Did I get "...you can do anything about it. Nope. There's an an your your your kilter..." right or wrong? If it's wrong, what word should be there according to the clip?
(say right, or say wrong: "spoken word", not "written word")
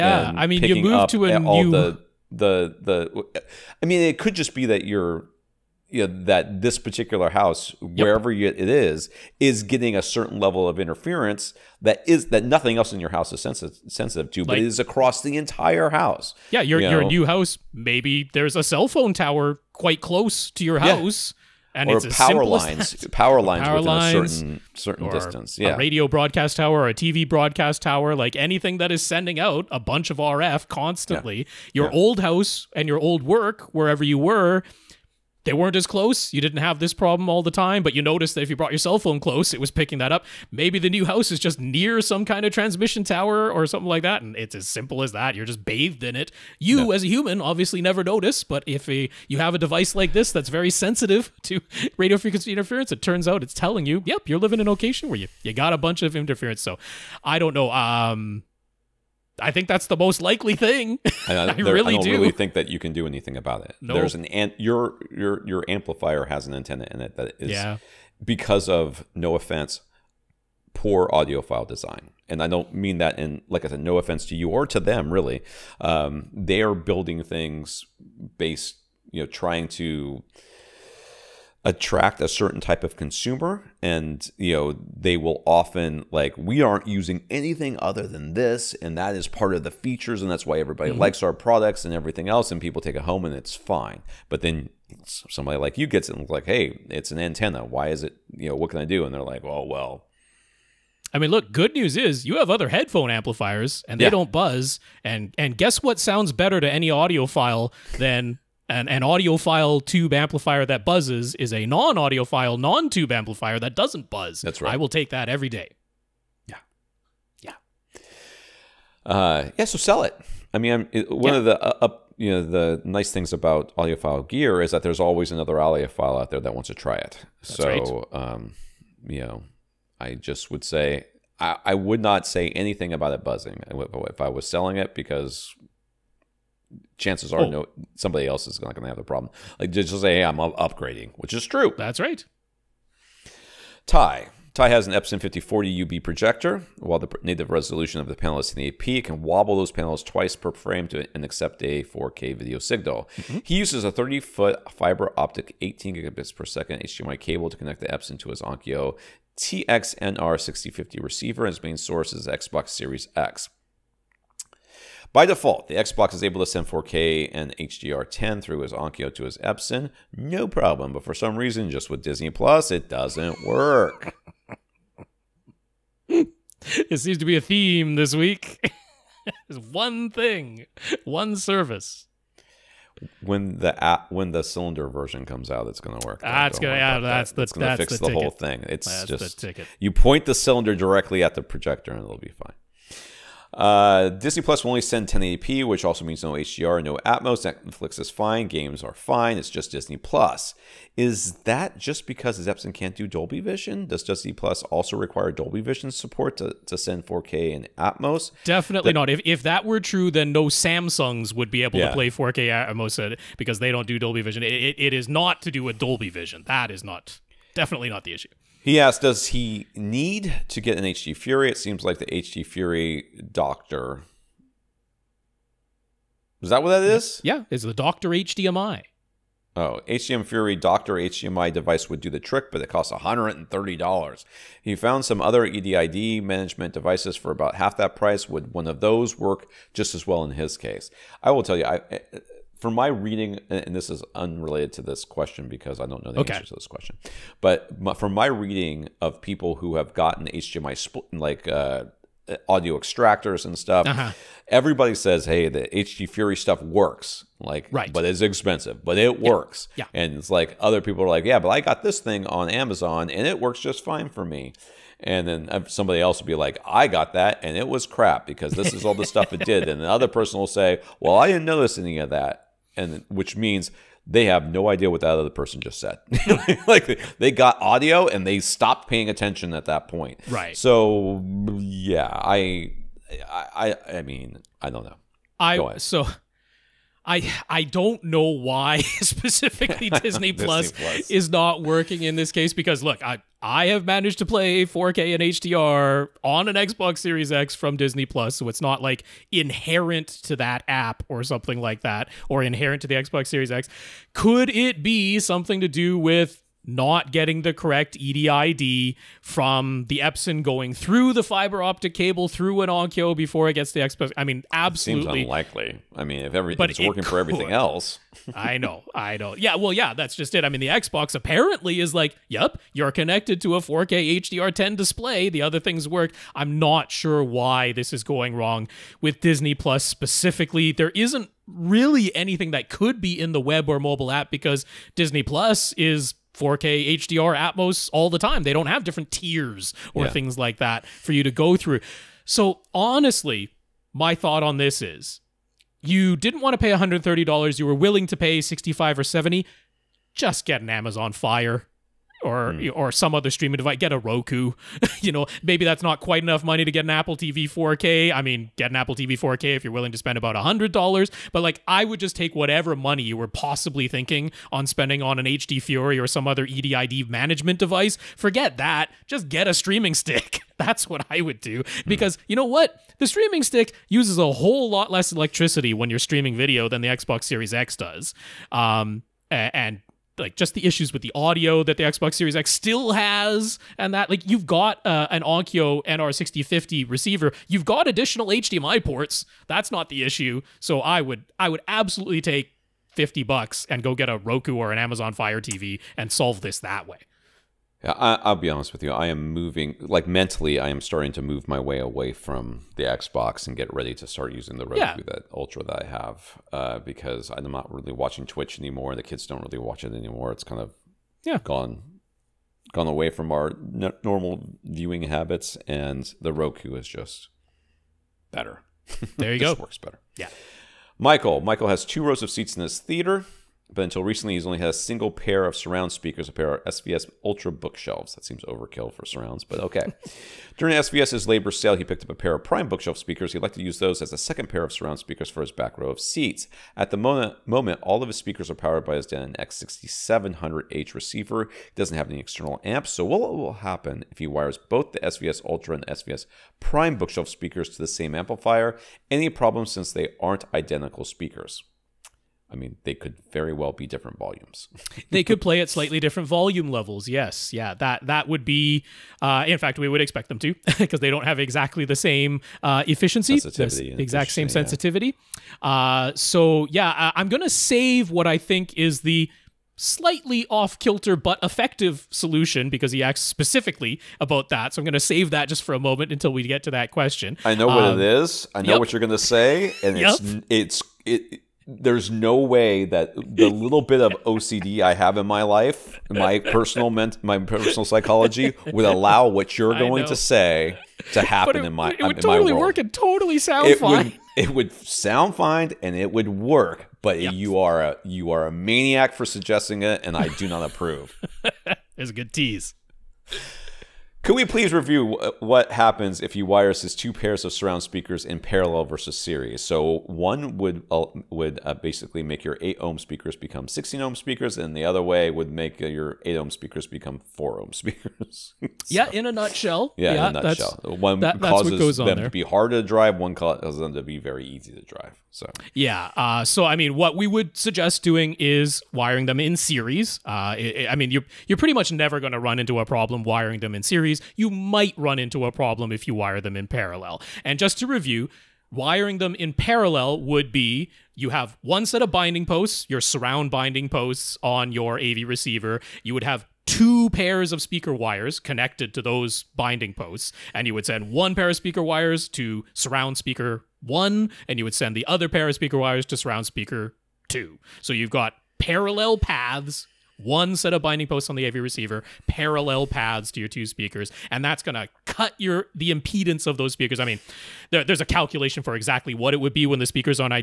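wrong: "amplifier", not "kilter".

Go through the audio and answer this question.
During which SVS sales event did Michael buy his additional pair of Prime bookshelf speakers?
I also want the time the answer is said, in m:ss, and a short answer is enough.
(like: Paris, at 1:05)
labor sale, at 7:11.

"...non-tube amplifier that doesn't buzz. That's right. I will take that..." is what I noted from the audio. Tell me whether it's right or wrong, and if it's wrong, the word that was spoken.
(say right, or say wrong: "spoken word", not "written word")
right.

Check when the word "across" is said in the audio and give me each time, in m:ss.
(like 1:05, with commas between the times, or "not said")
0:14.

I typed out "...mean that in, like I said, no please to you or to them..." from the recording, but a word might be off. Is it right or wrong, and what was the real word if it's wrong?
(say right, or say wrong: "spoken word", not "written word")
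wrong: "offense", not "please".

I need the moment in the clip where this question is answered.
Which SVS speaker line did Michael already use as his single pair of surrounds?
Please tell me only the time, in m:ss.
7:07.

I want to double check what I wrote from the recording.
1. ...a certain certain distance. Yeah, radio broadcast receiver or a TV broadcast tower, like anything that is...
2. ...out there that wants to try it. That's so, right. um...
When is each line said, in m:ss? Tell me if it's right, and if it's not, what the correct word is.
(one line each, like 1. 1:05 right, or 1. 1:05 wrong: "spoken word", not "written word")
1. 0:24 wrong: "tower", not "receiver"
2. 2:06 right.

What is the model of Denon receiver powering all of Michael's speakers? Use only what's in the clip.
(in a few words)
X6700H.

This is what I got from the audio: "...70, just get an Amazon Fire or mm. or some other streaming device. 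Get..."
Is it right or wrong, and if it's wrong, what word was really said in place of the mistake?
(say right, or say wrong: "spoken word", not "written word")
right.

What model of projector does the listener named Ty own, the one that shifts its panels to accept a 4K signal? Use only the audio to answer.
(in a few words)
Epson 5040 UB.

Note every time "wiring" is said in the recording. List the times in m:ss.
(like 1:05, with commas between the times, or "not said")
8:48, 8:53, 8:58.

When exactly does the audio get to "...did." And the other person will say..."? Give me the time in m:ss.
4:29.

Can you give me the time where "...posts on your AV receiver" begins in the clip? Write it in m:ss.
9:03.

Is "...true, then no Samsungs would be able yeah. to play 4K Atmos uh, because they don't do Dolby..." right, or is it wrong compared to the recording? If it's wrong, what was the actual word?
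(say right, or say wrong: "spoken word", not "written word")
right.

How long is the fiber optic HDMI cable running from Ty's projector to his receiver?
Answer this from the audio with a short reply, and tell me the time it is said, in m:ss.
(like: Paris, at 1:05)
30 foot, at 2:33.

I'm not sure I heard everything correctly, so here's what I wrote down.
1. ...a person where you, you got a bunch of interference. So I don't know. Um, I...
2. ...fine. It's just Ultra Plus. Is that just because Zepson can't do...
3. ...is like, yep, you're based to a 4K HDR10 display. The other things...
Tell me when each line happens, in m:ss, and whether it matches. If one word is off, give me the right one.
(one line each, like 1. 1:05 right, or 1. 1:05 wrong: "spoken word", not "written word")
1. 0:54 wrong: "location", not "person"
2. 3:18 wrong: "Disney", not "Ultra"
3. 5:21 wrong: "connected", not "based".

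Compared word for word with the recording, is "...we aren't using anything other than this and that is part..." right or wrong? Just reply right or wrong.
right.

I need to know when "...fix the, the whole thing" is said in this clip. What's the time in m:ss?
3:07.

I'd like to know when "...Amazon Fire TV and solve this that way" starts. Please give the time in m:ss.
6:34.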